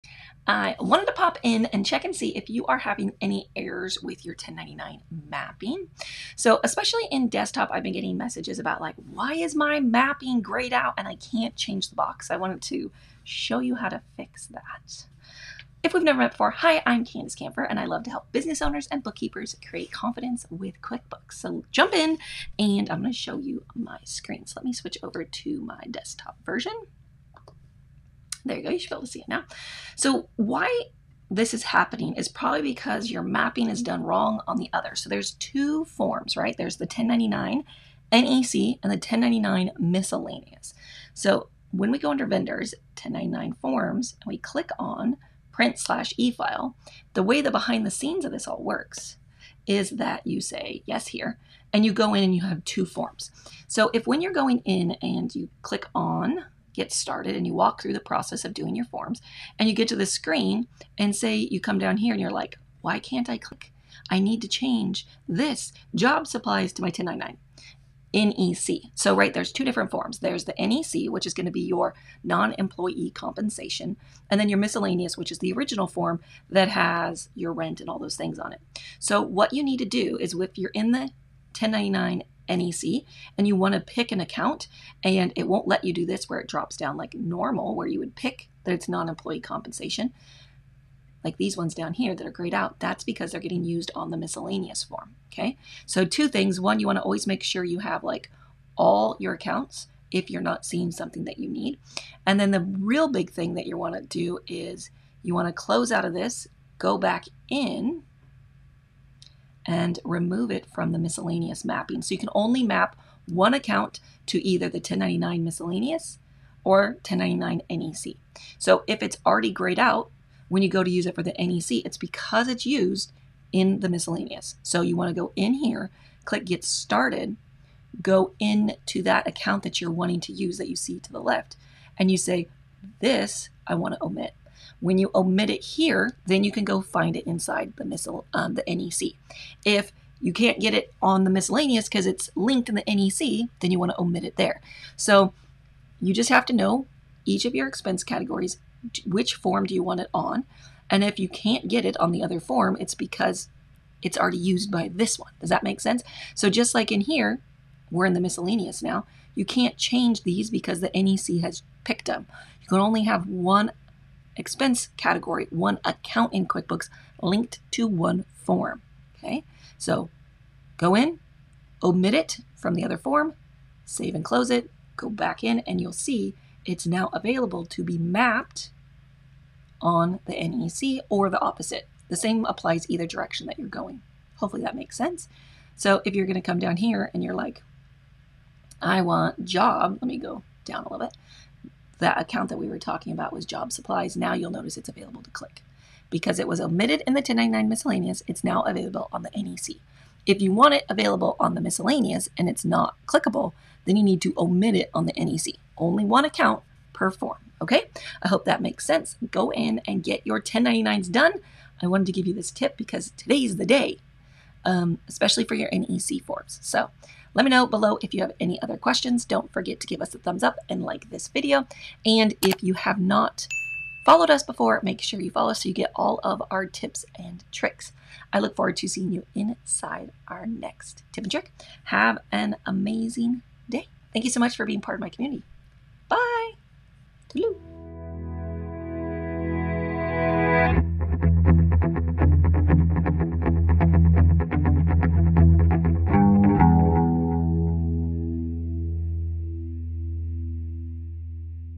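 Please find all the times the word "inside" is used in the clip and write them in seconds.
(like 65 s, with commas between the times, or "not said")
137 s, 229 s.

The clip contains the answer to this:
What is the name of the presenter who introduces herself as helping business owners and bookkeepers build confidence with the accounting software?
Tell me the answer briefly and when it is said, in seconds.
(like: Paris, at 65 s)
Candus Kampfer, at 17 s.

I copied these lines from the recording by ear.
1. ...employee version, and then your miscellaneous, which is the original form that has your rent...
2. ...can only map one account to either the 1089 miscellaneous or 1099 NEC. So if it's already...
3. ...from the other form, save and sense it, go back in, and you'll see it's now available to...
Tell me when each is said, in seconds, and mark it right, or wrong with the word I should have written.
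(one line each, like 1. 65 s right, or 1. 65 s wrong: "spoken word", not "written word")
1. 72 s wrong: "compensation", not "version"
2. 112 s wrong: "1099", not "1089"
3. 172 s wrong: "close", not "sense".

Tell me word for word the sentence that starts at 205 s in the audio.
Only one account per form, okay?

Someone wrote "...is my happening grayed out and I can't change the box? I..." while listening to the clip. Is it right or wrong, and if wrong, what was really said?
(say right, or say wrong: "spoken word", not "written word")
wrong: "mapping", not "happening".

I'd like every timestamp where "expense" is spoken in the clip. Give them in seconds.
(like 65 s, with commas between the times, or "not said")
147 s, 164 s.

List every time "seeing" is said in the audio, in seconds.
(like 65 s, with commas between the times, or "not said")
100 s, 228 s.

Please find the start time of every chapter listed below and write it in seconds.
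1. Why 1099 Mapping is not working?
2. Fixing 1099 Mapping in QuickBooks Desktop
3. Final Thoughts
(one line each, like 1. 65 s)
1. 29 s
2. 40 s
3. 216 s.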